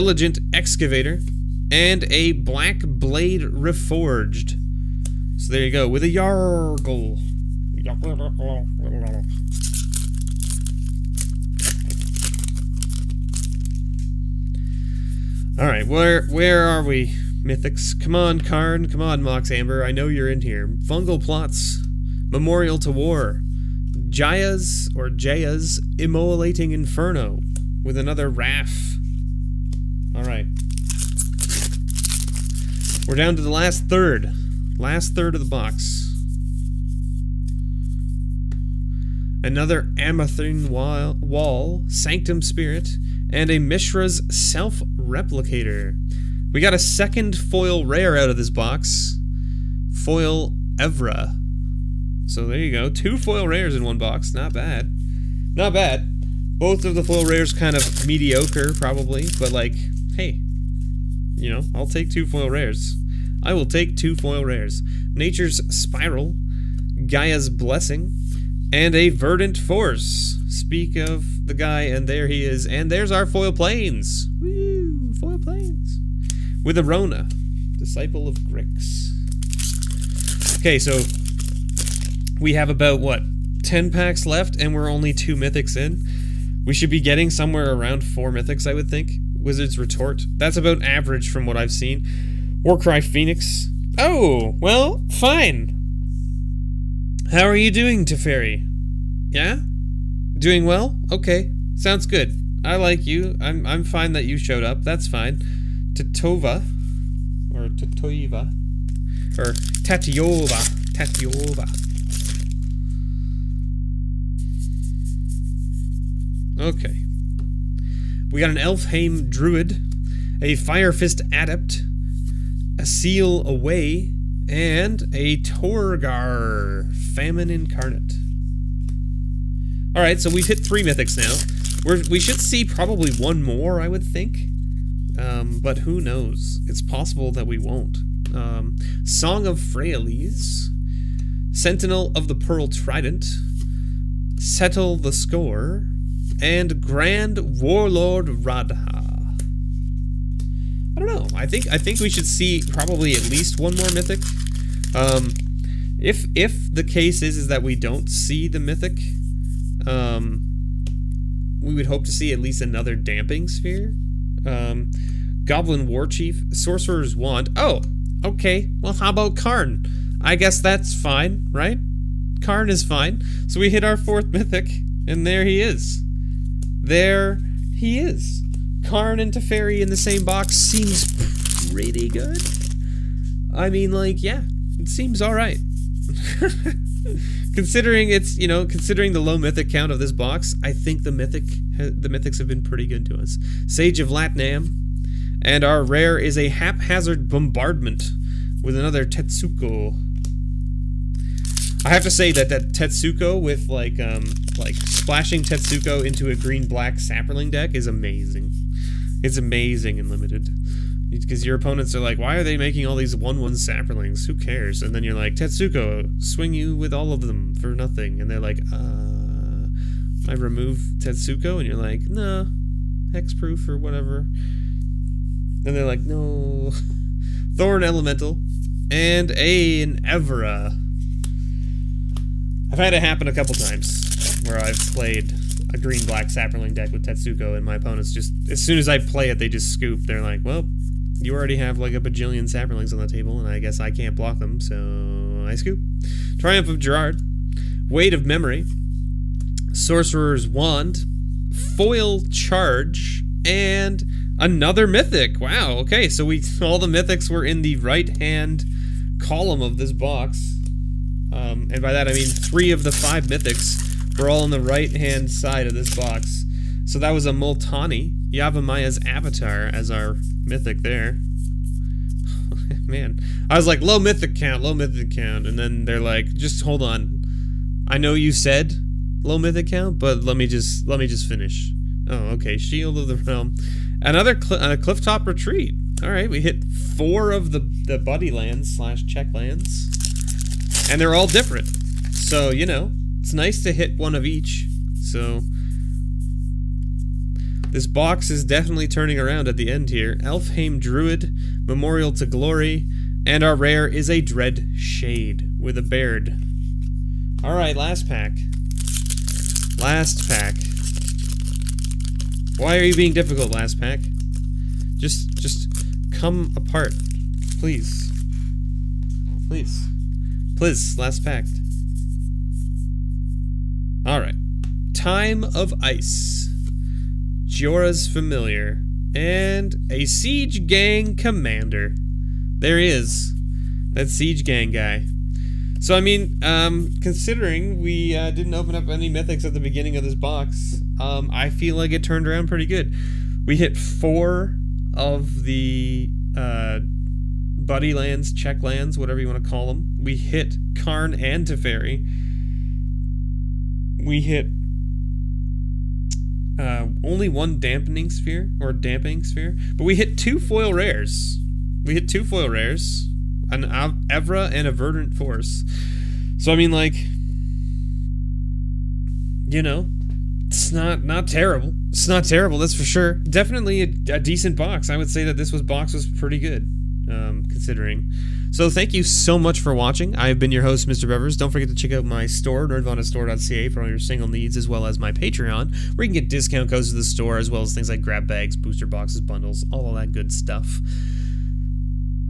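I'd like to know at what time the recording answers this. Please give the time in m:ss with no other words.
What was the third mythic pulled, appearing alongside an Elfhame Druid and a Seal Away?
2:05.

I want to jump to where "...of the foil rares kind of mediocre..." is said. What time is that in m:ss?
0:56.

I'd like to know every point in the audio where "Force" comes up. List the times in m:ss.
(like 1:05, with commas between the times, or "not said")
1:09, 6:05.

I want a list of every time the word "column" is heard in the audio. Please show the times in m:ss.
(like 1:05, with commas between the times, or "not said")
4:19.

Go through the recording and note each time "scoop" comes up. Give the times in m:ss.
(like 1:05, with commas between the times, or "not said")
3:59, 4:05.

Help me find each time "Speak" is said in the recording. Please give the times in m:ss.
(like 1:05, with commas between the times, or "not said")
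1:10.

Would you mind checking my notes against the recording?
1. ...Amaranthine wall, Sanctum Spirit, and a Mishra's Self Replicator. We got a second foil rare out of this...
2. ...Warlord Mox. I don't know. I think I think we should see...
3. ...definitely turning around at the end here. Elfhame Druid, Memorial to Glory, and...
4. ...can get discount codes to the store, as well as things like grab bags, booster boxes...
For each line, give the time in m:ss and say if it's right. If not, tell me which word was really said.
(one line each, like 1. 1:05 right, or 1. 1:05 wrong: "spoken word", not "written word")
1. 0:39 right
2. 2:27 wrong: "Radha", not "Mox"
3. 4:58 right
4. 6:26 right.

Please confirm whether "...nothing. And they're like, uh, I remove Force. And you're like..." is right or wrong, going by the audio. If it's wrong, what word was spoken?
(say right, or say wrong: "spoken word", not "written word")
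wrong: "Tetsuko", not "Force".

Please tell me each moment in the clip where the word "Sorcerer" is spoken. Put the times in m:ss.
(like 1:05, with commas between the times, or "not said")
2:46, 4:09.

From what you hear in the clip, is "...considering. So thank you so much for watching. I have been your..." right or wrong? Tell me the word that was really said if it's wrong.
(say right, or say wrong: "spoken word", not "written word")
right.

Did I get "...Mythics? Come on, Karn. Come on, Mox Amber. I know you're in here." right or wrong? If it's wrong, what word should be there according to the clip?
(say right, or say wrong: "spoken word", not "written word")
right.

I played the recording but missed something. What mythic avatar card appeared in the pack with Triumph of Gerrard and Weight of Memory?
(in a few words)
Multani, Yavimaya's Avatar.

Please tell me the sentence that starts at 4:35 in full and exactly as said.
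And then they're like, just hold on.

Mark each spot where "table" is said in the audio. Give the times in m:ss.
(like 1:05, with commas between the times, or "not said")
4:03.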